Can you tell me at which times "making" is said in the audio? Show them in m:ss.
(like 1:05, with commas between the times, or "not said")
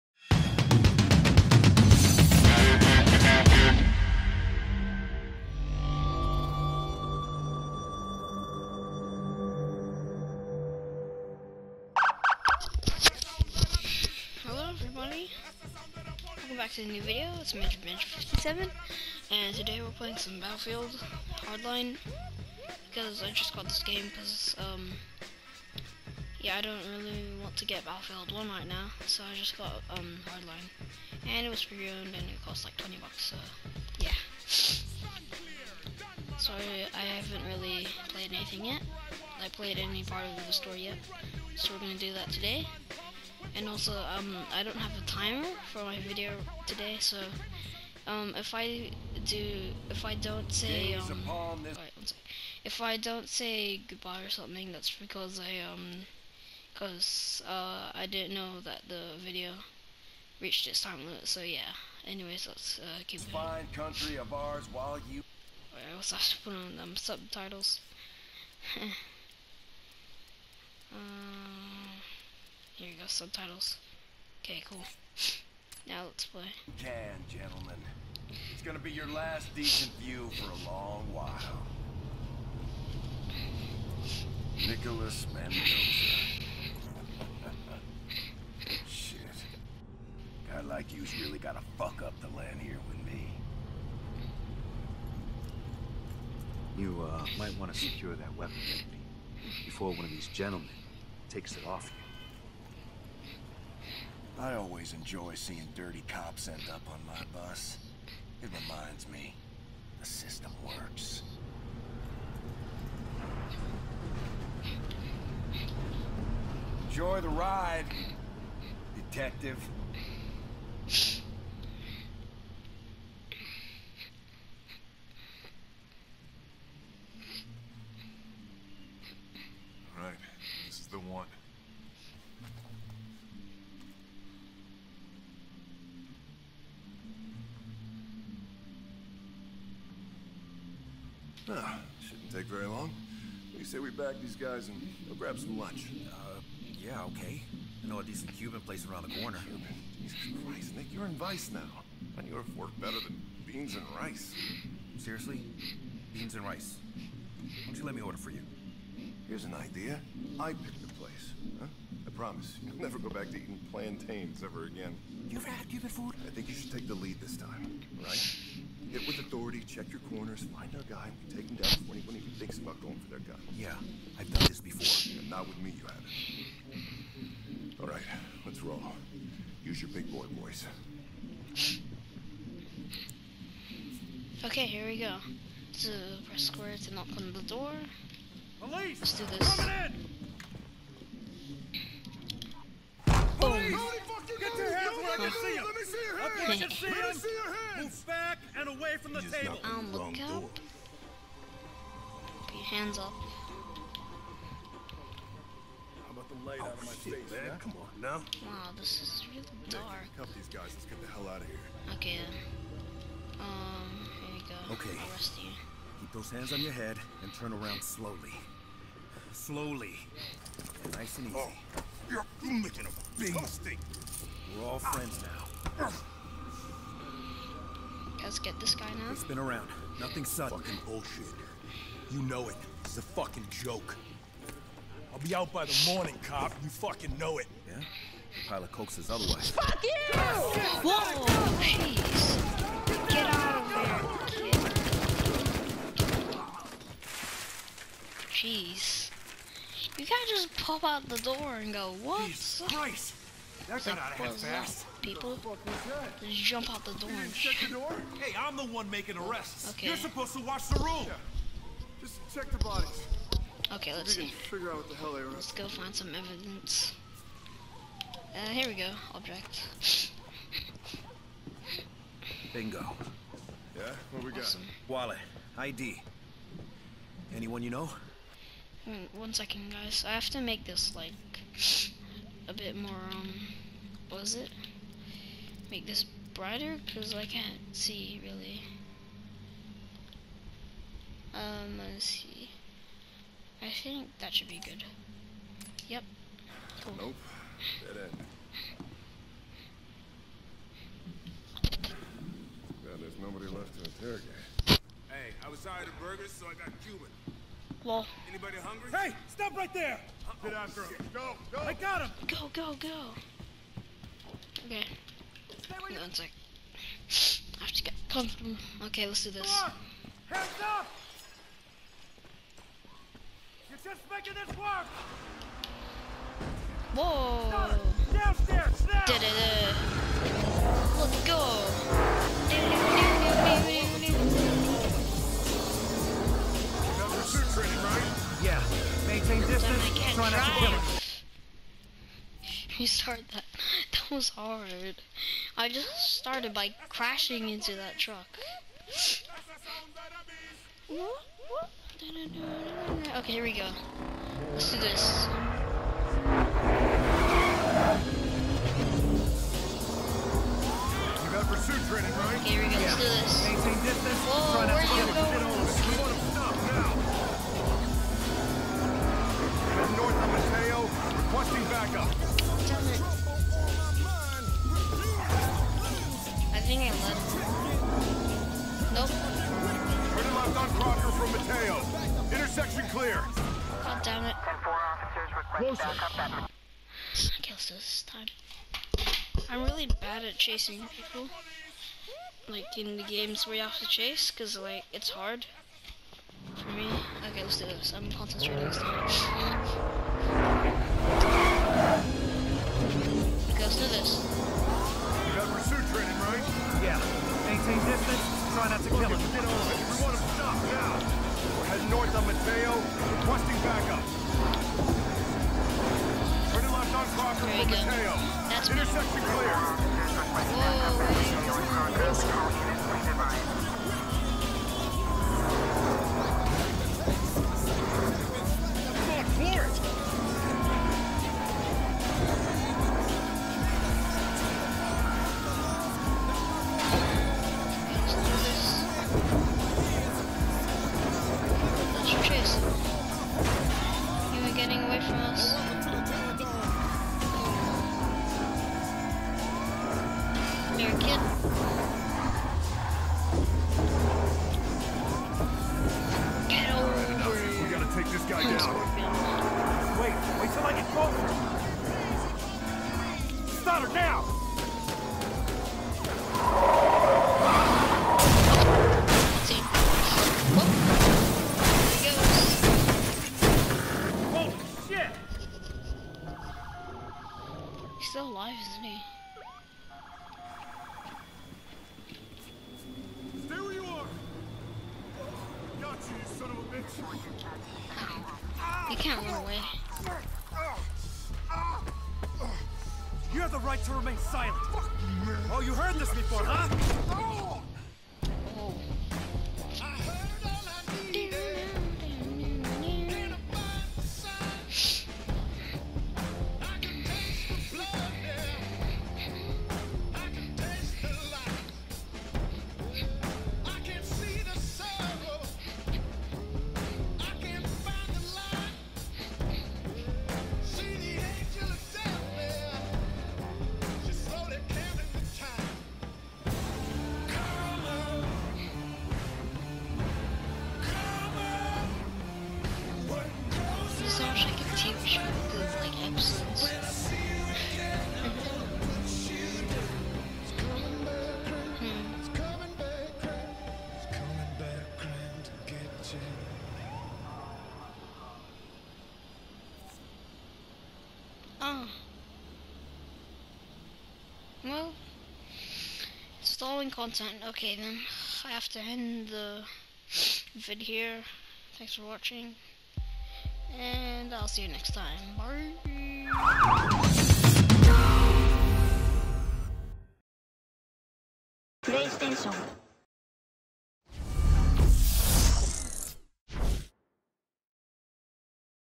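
3:42, 4:18, 5:24.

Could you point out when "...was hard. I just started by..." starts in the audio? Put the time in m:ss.
5:44.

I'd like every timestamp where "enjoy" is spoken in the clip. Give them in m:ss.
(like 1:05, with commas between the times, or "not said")
1:44, 1:56.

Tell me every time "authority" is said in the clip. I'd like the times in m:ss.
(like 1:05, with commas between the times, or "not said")
2:49.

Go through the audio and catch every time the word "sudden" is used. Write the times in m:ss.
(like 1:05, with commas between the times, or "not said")
3:50.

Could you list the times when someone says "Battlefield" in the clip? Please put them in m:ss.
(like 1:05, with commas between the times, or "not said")
0:20, 0:27.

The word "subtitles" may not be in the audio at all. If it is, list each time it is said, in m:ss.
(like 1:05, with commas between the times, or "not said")
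1:06, 1:13.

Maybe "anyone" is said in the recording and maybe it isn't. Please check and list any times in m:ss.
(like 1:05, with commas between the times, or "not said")
2:51, 4:37.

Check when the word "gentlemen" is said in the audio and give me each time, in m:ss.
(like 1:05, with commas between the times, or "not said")
1:17, 1:40.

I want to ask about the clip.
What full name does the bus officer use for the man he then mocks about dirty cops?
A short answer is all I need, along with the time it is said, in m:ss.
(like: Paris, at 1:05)
Nicholas Mendoza, at 1:24.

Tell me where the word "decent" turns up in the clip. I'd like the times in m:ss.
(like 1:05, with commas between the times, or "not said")
1:19, 2:28.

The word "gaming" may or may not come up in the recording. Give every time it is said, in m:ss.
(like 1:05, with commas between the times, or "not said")
not said.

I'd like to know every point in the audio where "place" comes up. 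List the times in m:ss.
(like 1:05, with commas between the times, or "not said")
2:28, 2:40.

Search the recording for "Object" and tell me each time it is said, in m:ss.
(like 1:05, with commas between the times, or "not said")
4:29.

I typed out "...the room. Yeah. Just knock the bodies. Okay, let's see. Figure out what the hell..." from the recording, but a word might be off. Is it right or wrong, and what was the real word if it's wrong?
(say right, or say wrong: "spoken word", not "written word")
wrong: "check", not "knock".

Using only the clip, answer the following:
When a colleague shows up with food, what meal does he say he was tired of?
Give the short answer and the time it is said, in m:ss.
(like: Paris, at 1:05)
burgers, at 5:05.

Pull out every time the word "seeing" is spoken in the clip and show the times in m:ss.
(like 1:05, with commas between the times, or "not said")
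1:45.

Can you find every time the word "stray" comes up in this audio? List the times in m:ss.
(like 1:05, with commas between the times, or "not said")
not said.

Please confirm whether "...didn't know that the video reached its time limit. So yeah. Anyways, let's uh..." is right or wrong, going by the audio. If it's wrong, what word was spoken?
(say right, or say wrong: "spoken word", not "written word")
right.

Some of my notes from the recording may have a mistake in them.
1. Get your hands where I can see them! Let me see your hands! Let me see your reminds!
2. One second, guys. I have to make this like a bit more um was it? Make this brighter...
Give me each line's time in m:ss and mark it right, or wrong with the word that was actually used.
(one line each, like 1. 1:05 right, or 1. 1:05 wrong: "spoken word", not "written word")
1. 3:14 wrong: "hands", not "reminds"
2. 4:39 right.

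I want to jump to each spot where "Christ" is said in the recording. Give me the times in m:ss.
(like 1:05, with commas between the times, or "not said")
2:30, 4:12.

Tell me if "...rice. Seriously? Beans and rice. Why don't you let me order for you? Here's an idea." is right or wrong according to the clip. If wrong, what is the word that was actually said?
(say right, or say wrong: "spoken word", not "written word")
right.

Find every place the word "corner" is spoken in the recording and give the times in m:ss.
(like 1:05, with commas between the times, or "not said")
2:29, 2:50.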